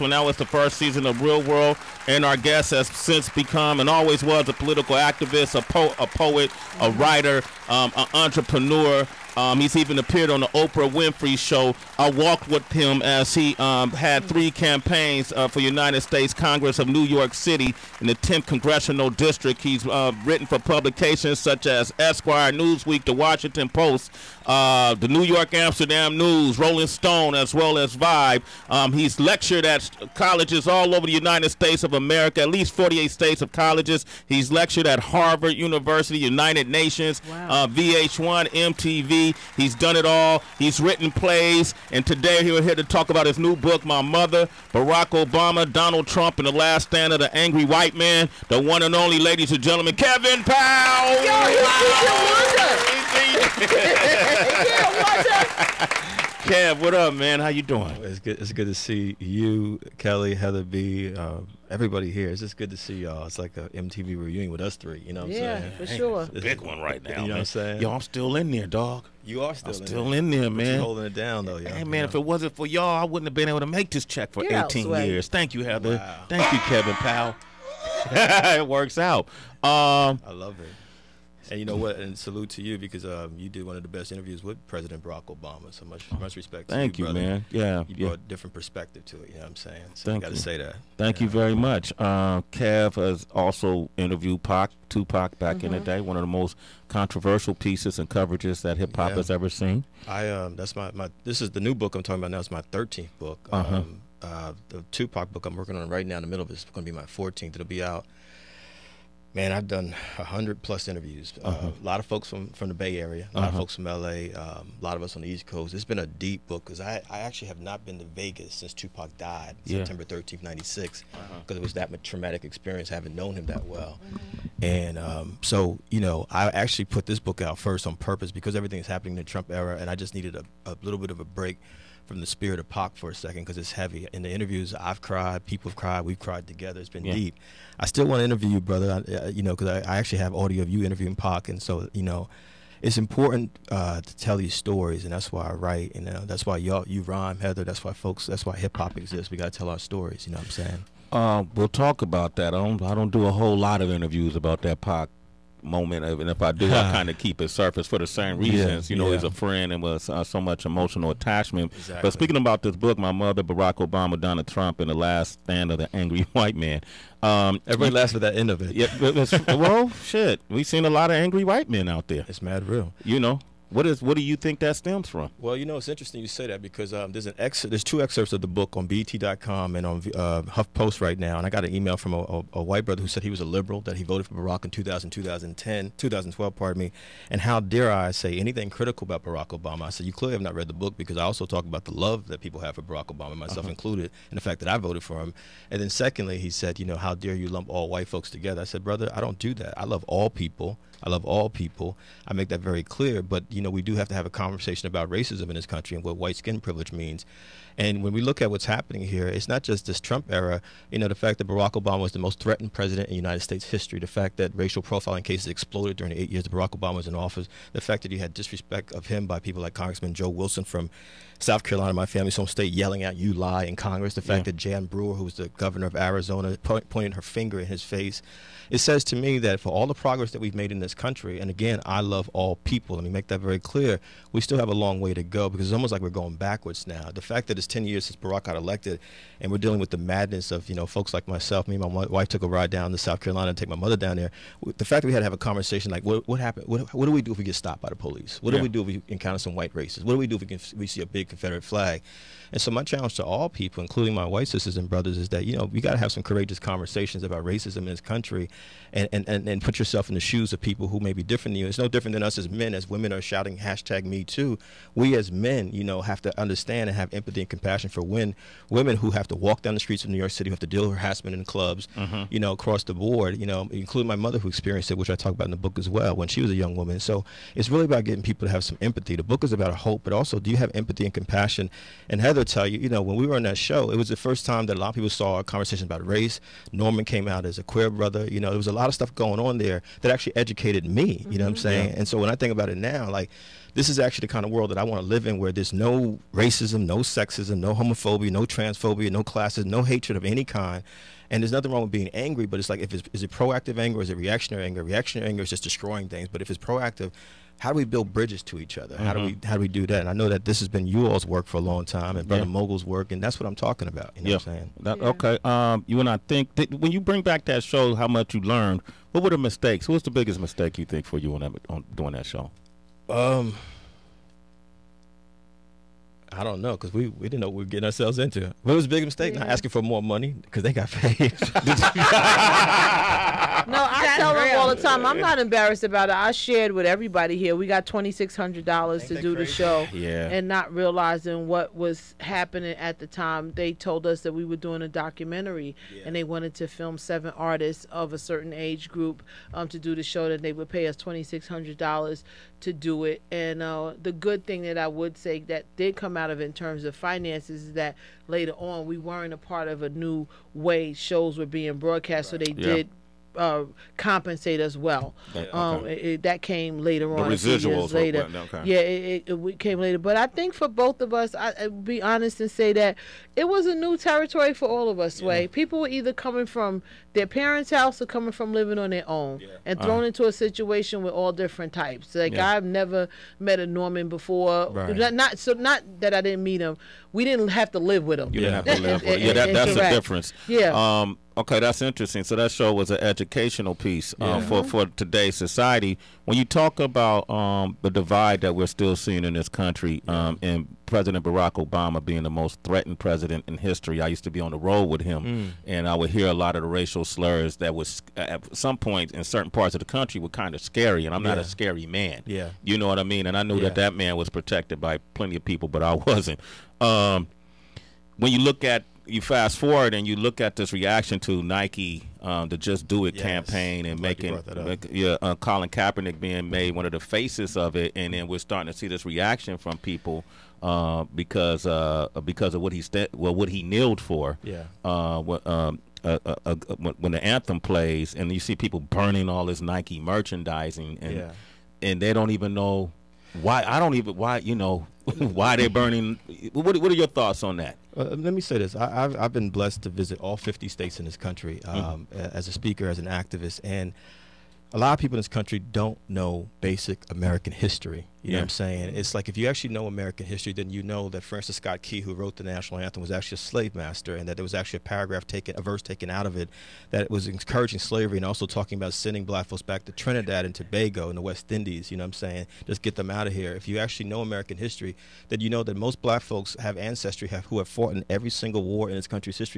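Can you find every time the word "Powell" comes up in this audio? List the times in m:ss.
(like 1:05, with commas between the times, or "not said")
0:50, 1:16.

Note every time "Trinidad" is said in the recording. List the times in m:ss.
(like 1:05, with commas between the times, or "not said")
7:49.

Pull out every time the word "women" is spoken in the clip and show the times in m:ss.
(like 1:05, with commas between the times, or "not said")
4:22, 4:28.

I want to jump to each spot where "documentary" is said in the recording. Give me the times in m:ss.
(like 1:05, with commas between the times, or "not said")
5:44.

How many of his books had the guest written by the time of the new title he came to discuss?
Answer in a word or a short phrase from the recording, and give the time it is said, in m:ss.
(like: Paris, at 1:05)
13, at 1:42.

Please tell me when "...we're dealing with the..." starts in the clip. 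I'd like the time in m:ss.
3:59.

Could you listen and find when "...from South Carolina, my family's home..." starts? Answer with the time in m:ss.
3:40.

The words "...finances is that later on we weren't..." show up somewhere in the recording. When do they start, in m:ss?
5:56.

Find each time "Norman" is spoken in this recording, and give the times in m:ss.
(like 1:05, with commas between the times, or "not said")
4:46, 6:23.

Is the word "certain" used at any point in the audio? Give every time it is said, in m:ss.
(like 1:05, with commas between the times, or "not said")
5:48, 6:49.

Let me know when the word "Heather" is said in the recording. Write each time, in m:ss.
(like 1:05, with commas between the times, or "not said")
1:00, 1:15, 2:27, 4:42.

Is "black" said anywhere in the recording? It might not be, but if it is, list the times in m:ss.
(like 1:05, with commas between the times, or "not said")
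7:49, 7:56.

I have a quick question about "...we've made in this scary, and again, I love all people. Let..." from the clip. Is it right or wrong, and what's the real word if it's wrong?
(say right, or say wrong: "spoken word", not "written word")
wrong: "country", not "scary".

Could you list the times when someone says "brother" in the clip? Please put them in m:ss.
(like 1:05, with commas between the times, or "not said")
2:18, 3:02, 3:18, 4:14, 4:47, 5:12.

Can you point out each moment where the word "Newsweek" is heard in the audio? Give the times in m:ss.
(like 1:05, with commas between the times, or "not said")
0:22.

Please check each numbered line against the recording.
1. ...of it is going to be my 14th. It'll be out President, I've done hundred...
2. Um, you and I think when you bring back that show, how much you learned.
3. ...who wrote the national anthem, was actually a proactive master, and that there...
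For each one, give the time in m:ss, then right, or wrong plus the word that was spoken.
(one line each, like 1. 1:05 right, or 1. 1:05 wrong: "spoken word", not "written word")
1. 1:46 wrong: "Man", not "President"
2. 5:15 right
3. 7:42 wrong: "slave", not "proactive".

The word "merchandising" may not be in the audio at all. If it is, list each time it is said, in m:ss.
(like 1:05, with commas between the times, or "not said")
7:19.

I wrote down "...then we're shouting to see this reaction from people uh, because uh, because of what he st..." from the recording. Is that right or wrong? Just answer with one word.
wrong.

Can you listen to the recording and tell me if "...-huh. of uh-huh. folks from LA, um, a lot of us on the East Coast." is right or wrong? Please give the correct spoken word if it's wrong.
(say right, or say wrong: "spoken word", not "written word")
right.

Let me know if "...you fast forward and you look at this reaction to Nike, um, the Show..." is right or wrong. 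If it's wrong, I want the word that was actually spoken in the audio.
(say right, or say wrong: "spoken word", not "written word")
wrong: "Just", not "Show".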